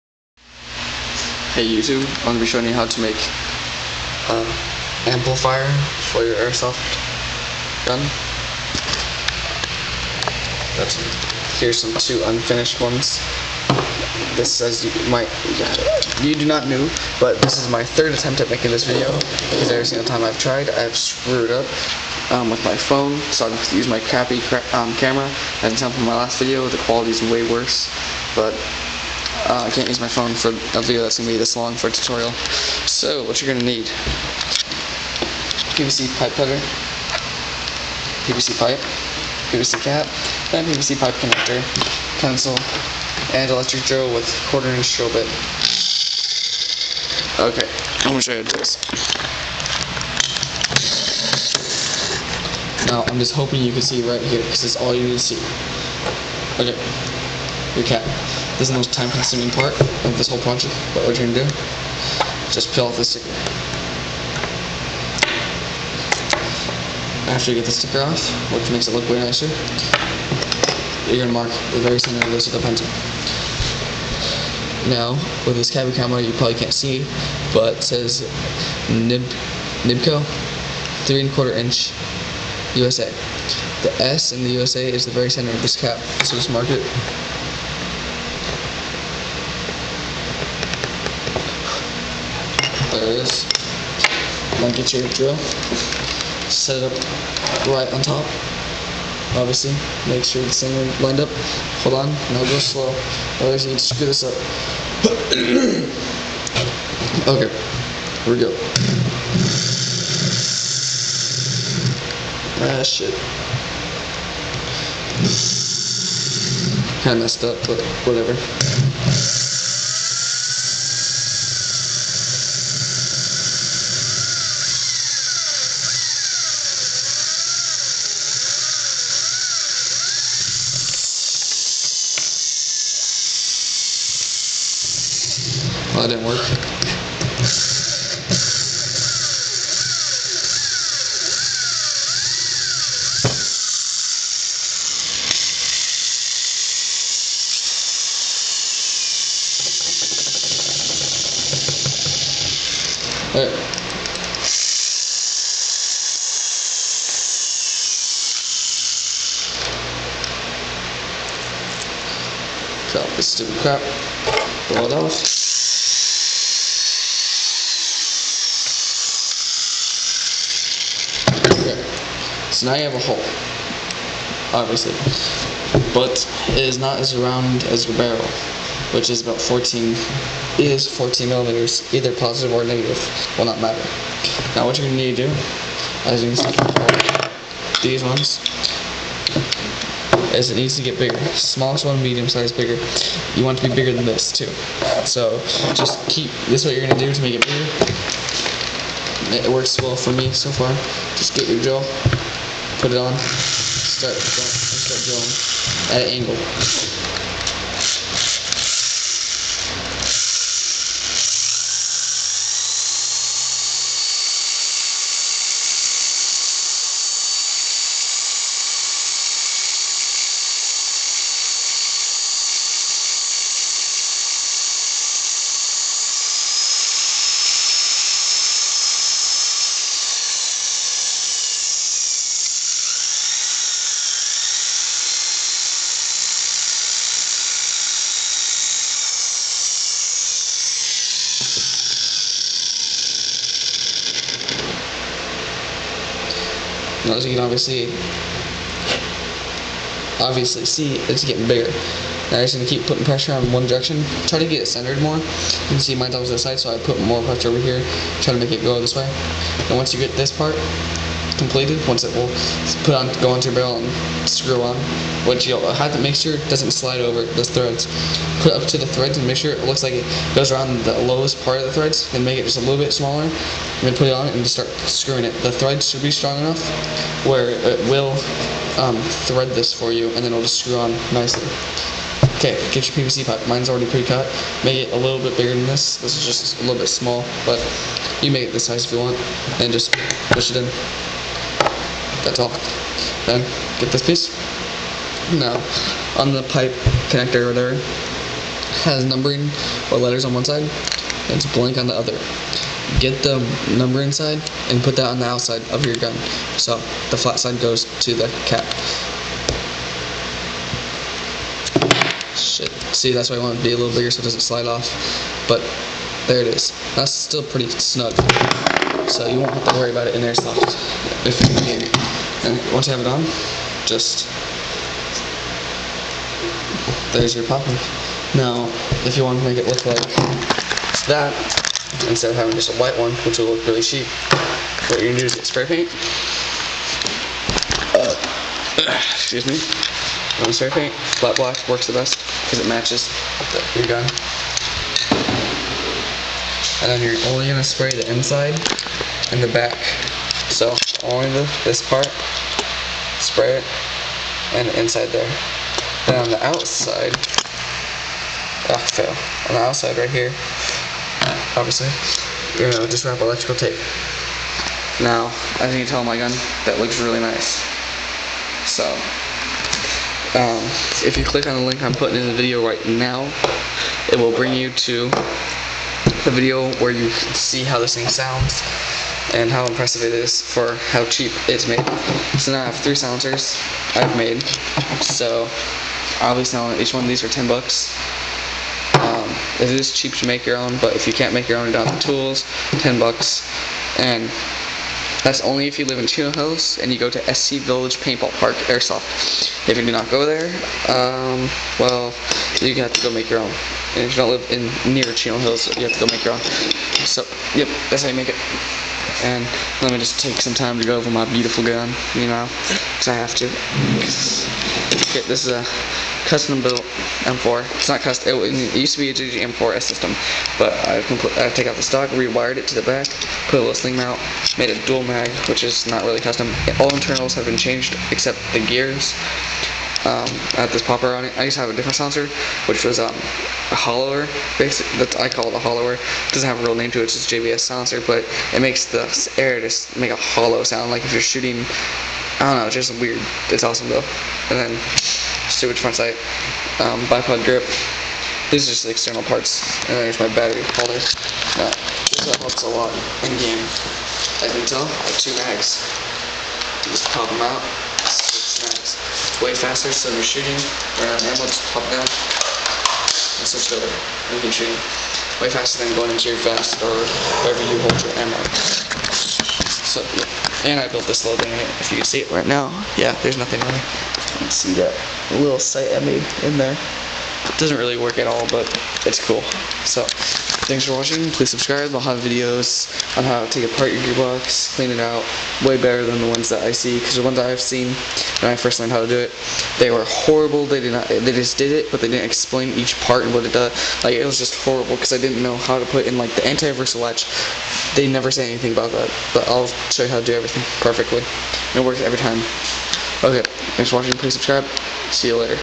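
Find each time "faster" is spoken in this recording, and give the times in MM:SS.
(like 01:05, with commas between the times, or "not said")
07:39, 07:45.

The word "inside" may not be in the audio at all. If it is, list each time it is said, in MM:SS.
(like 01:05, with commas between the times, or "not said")
05:04, 05:48, 05:54.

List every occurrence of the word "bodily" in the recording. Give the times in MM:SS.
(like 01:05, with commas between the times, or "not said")
not said.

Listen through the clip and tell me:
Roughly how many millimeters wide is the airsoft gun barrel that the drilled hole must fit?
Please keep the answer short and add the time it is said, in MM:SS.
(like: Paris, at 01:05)
14, at 03:00.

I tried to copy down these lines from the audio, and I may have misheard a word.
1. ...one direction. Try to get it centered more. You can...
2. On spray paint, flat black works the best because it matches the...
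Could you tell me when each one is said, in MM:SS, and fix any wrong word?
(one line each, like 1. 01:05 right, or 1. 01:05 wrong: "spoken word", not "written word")
1. 04:13 right
2. 05:40 right.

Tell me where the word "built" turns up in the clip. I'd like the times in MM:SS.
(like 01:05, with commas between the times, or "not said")
06:56, 07:50.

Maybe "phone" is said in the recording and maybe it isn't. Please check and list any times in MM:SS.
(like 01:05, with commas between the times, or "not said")
00:22, 00:30.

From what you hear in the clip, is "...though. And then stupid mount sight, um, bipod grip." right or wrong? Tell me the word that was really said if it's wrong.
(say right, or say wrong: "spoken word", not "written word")
wrong: "front", not "mount".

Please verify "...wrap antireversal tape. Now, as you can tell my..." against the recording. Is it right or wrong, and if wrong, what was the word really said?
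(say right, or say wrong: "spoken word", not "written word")
wrong: "electrical", not "antireversal".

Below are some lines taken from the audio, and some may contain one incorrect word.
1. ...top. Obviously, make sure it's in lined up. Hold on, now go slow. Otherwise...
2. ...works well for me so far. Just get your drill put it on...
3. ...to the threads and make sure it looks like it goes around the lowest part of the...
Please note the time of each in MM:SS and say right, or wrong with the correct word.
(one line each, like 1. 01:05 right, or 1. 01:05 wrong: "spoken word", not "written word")
1. 01:38 right
2. 03:19 right
3. 04:28 right.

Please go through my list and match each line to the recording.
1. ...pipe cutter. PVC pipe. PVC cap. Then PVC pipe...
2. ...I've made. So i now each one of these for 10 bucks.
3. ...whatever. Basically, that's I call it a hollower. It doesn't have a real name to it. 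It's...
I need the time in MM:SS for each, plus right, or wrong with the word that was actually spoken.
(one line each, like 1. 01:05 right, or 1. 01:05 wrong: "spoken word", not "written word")
1. 00:36 right
2. 06:23 right
3. 07:13 wrong: "hollower", not "whatever".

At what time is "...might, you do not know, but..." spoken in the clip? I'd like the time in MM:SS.
00:15.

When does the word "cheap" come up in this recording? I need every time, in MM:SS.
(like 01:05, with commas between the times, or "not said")
05:33, 06:21, 06:29.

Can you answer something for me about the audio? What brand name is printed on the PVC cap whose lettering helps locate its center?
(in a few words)
Nibco.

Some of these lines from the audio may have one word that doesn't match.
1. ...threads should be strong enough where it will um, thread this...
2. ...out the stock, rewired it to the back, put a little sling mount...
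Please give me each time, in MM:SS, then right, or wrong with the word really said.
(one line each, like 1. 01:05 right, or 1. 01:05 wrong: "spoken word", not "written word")
1. 04:35 right
2. 07:01 right.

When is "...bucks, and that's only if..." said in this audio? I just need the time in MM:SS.
06:32.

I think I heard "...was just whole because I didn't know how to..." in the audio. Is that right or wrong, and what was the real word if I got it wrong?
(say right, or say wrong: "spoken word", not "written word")
wrong: "horrible", not "whole".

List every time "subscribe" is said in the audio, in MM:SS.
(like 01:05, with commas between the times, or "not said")
08:01, 08:24.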